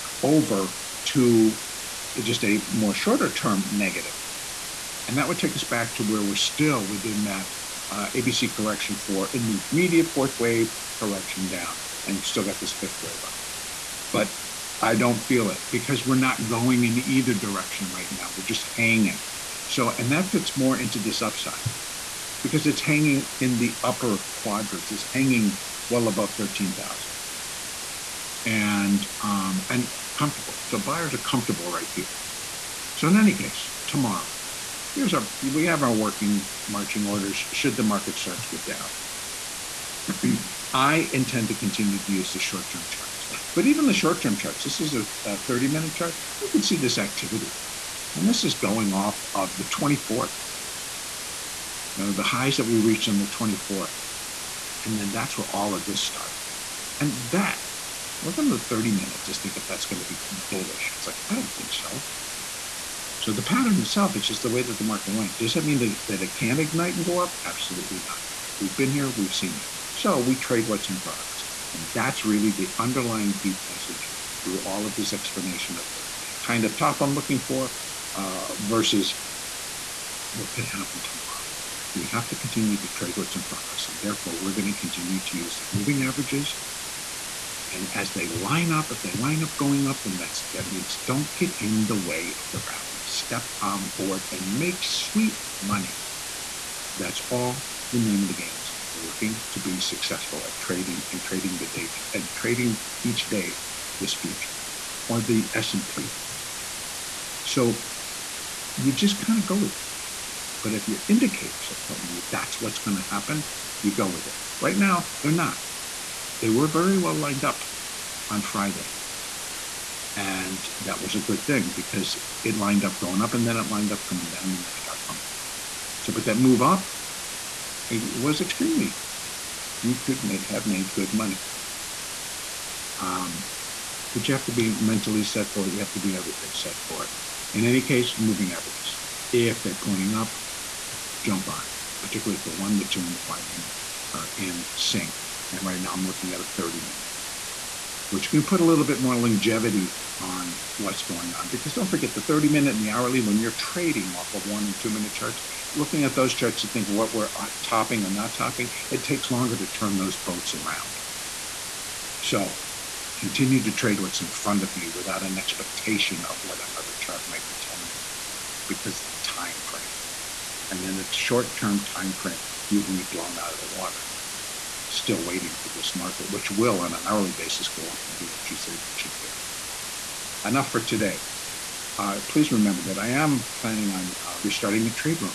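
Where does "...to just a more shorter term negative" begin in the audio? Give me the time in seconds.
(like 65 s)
1 s.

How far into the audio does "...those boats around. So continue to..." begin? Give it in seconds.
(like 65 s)
159 s.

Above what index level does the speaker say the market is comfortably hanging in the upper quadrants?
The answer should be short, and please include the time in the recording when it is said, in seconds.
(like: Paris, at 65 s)
13,000, at 26 s.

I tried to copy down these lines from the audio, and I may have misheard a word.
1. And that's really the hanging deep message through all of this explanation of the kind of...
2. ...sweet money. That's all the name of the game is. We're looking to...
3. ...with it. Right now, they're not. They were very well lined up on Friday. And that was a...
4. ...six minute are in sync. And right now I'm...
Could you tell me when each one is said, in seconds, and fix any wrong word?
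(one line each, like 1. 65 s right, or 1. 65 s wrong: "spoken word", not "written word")
1. 71 s wrong: "underlying", not "hanging"
2. 94 s right
3. 114 s right
4. 143 s wrong: "five", not "six".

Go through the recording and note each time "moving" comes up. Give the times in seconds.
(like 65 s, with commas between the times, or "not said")
85 s, 138 s.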